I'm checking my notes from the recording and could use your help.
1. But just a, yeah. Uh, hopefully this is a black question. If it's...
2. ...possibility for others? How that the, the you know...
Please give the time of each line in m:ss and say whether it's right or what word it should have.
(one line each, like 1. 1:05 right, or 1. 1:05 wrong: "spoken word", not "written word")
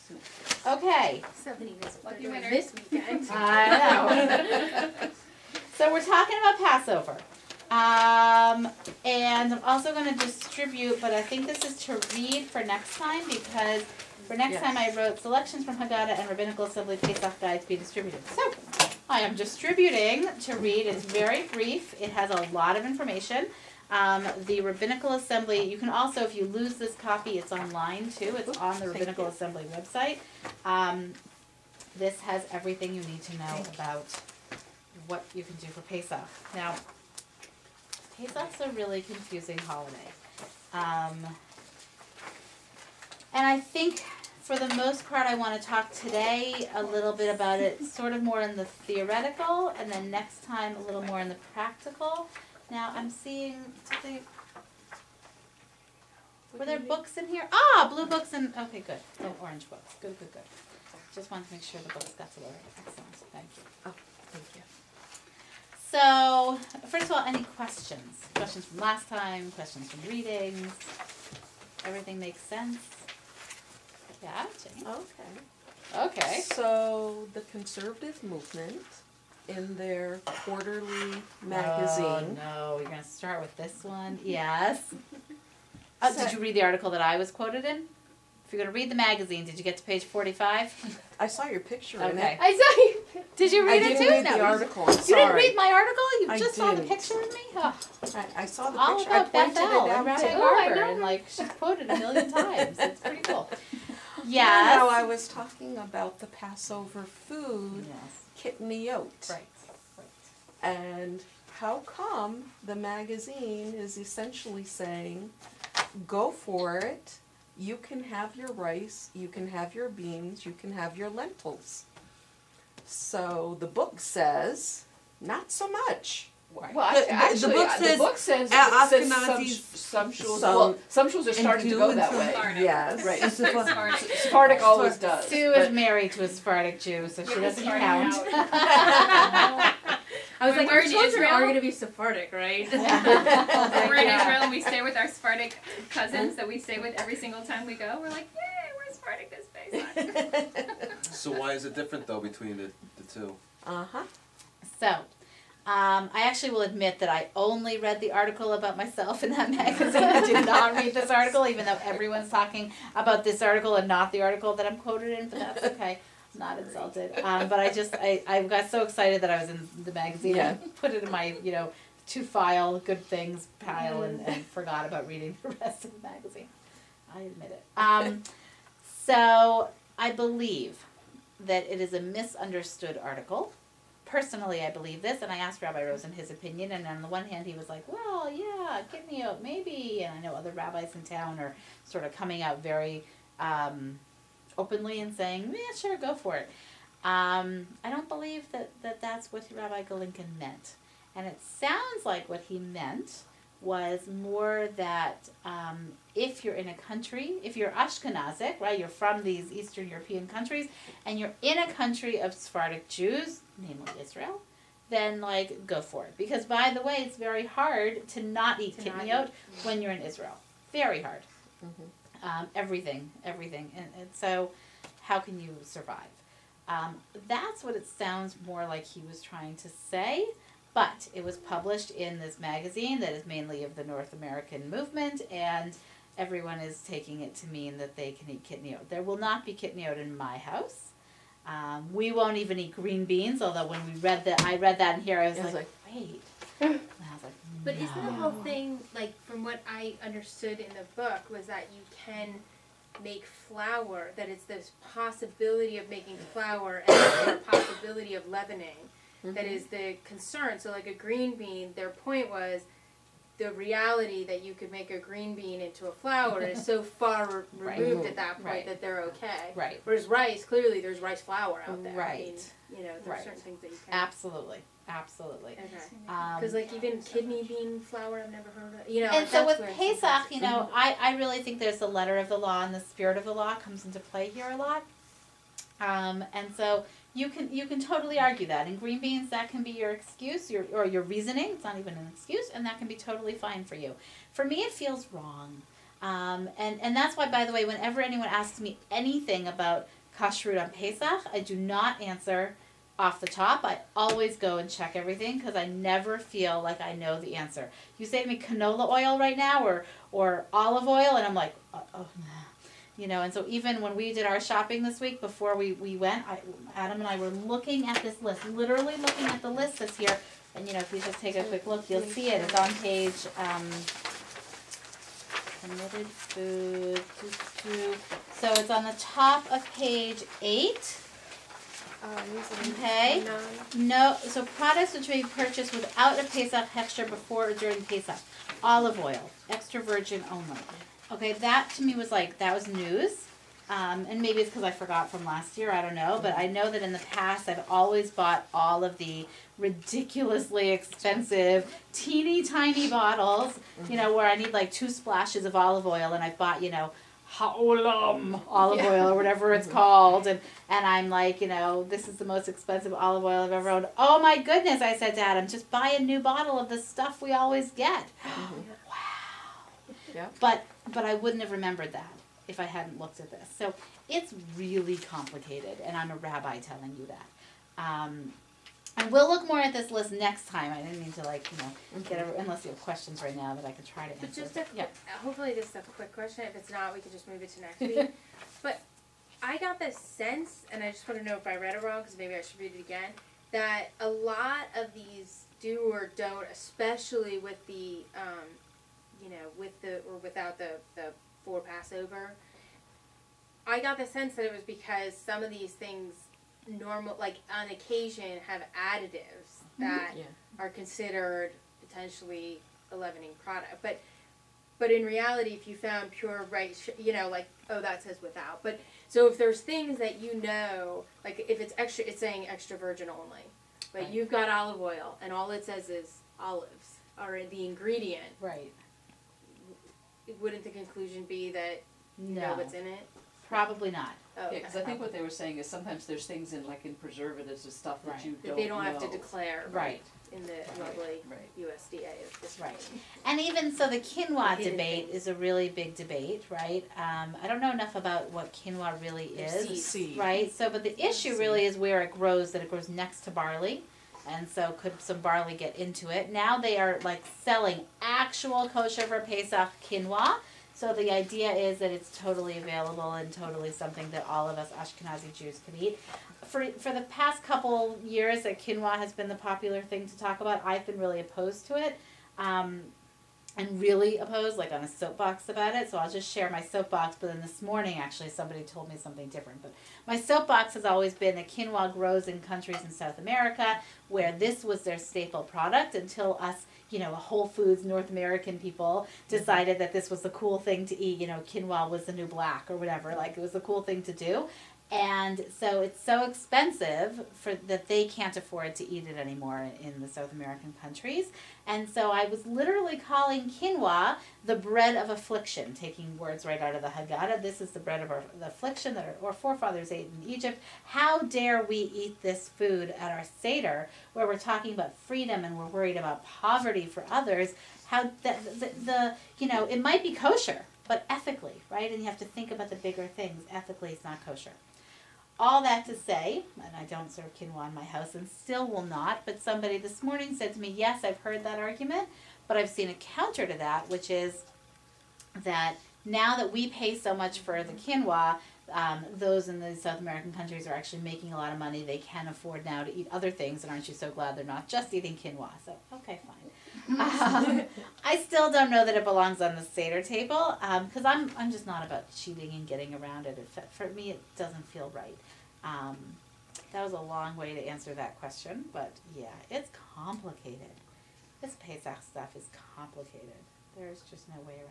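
1. 6:24 wrong: "quick", not "black"
2. 8:36 wrong: "poverty", not "possibility".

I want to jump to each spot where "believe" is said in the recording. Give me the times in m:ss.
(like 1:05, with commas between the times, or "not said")
3:00, 3:04, 3:18.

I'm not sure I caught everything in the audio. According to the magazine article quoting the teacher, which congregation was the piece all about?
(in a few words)
Beth El.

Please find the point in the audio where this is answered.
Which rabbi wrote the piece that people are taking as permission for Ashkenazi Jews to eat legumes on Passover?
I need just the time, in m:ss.
3:19.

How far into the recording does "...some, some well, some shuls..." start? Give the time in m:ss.
2:09.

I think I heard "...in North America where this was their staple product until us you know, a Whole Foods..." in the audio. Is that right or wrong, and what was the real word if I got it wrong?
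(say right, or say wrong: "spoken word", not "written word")
wrong: "South", not "North".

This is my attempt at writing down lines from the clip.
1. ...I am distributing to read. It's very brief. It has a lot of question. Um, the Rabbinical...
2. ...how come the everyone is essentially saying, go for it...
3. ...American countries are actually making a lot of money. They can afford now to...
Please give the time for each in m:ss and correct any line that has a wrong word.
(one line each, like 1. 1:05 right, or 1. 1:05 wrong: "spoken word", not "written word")
1. 0:19 wrong: "information", not "question"
2. 1:51 wrong: "magazine", not "everyone"
3. 8:59 right.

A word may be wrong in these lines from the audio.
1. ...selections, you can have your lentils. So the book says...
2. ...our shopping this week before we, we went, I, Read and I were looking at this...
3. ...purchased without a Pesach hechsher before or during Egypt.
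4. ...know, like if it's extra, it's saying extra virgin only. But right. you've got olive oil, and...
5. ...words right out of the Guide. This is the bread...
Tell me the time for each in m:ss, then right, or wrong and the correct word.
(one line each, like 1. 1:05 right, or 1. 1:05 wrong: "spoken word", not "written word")
1. 1:59 wrong: "beans", not "selections"
2. 5:14 wrong: "Adam", not "Read"
3. 5:35 wrong: "Pesach", not "Egypt"
4. 7:00 right
5. 8:26 wrong: "Haggadah", not "Guide".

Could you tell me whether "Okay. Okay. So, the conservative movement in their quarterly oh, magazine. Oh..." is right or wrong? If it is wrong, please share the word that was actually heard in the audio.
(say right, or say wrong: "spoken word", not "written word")
right.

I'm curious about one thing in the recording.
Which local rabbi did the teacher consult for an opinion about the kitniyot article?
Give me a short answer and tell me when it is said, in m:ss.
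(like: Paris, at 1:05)
Rabbi Rosen, at 3:05.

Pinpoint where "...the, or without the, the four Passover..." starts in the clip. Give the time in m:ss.
6:39.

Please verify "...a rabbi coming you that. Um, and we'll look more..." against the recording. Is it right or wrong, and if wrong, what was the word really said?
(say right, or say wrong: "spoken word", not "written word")
wrong: "telling", not "coming".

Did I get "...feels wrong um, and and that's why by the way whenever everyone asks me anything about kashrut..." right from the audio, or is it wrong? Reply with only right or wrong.
wrong.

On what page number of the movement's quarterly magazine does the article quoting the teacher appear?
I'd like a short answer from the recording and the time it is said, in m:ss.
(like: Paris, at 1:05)
45, at 1:30.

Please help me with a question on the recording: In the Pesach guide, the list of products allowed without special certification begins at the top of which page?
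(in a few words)
8.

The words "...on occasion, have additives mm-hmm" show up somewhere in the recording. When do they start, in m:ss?
6:47.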